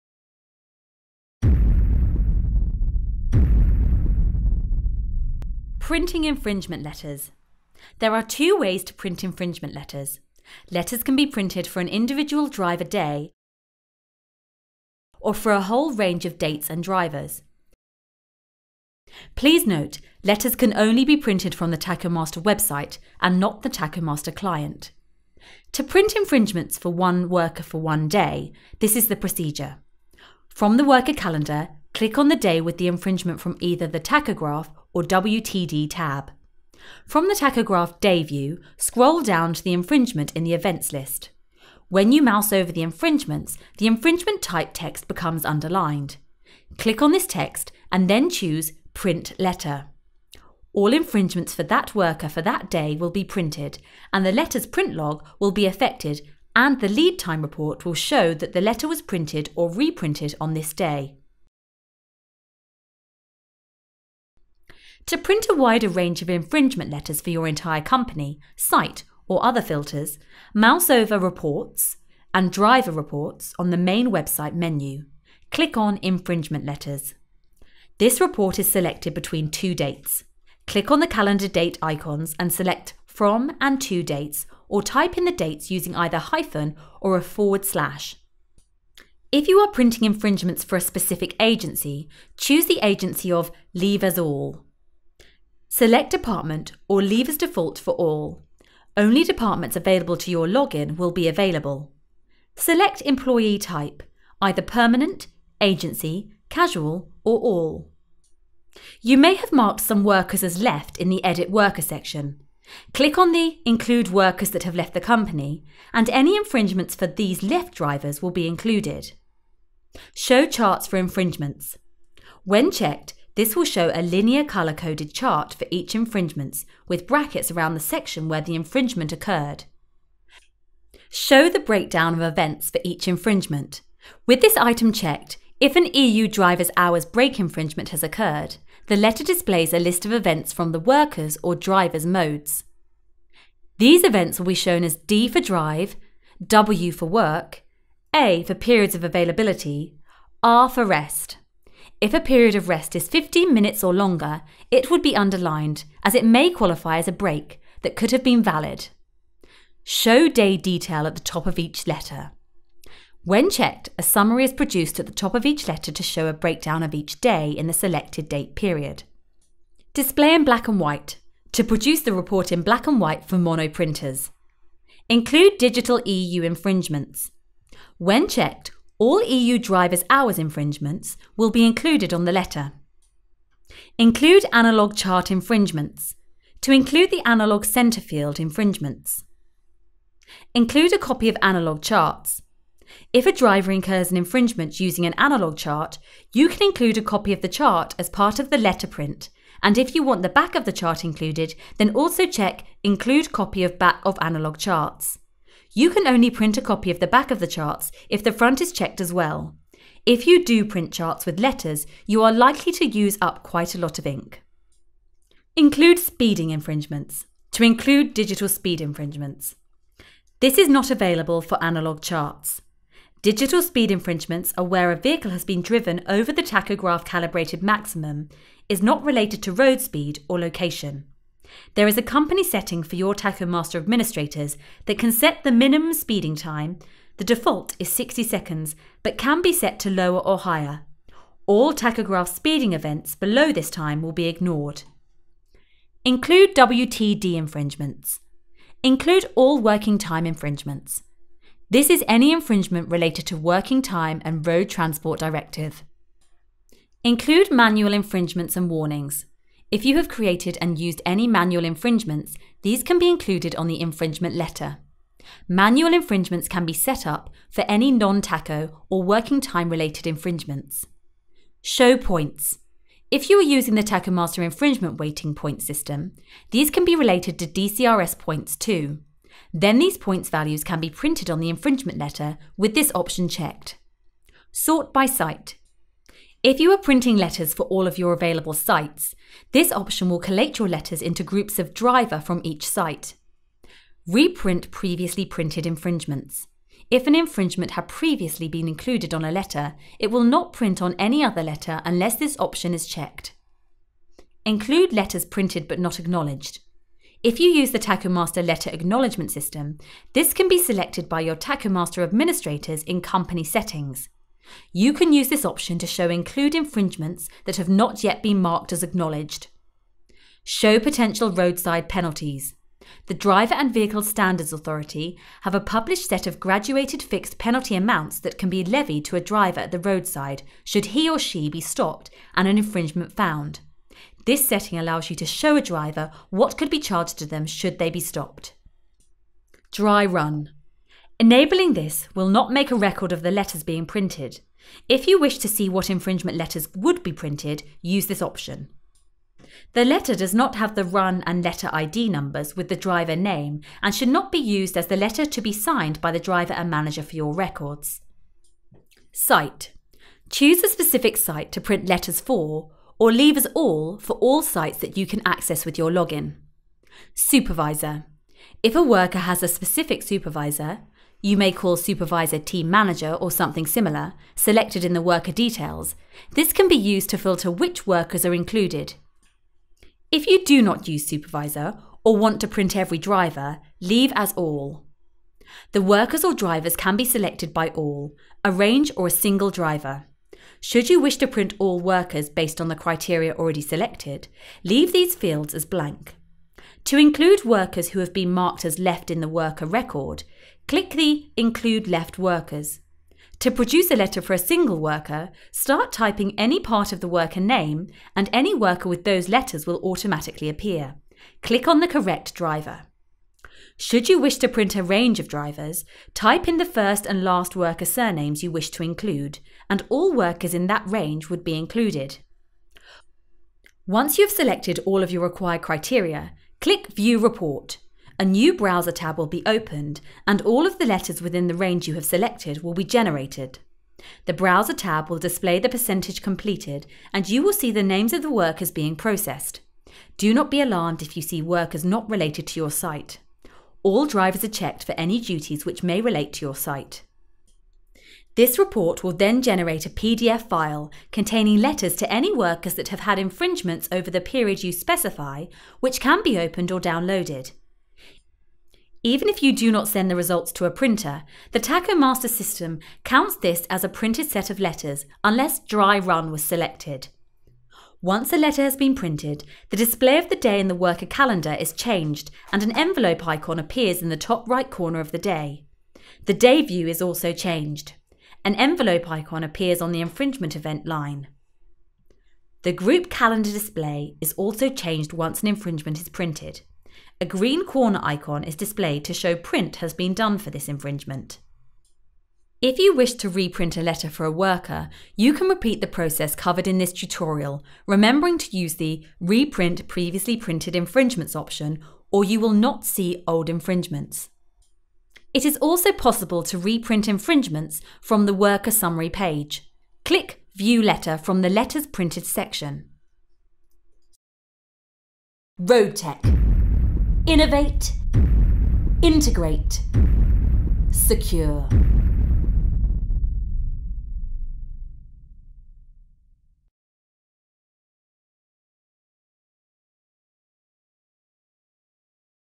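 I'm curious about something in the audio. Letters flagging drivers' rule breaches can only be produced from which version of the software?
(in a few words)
Tachomaster website.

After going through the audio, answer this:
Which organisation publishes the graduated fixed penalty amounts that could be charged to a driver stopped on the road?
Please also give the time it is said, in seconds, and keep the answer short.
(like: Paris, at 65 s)
Driver and Vehicle Standards Authority, at 323 s.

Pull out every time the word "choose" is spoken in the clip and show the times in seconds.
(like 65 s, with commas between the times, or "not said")
48 s, 92 s, 360 s.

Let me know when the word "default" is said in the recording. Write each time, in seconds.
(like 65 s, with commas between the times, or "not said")
97 s, 237 s.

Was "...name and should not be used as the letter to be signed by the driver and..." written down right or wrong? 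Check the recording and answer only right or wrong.
right.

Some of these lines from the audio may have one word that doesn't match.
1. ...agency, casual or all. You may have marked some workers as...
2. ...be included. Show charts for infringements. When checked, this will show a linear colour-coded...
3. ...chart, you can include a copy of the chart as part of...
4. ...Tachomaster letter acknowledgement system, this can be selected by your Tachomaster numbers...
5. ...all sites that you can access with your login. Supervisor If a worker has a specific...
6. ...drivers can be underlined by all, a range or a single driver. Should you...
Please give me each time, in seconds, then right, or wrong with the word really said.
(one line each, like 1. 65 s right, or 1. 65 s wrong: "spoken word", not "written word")
1. 105 s right
2. 118 s right
3. 195 s right
4. 307 s wrong: "administrators", not "numbers"
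5. 364 s right
6. 386 s wrong: "selected", not "underlined".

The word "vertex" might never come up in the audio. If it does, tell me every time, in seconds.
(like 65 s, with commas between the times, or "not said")
not said.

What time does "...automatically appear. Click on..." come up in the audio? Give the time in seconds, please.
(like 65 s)
409 s.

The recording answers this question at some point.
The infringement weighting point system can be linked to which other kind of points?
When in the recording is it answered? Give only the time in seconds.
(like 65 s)
277 s.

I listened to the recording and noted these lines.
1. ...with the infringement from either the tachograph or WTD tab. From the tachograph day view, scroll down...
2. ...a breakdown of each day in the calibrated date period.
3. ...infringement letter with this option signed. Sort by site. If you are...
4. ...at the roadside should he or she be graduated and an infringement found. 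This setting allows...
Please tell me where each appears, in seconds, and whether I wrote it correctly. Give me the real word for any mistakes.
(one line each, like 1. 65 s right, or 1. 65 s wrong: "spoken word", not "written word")
1. 32 s right
2. 166 s wrong: "selected", not "calibrated"
3. 281 s wrong: "checked", not "signed"
4. 329 s wrong: "stopped", not "graduated".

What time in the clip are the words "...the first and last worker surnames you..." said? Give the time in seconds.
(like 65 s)
416 s.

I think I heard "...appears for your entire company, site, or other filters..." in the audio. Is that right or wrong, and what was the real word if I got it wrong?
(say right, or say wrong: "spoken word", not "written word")
wrong: "letters", not "appears".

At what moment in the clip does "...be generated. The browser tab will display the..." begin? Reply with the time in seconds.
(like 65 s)
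432 s.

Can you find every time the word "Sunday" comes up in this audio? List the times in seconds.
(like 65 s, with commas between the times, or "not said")
not said.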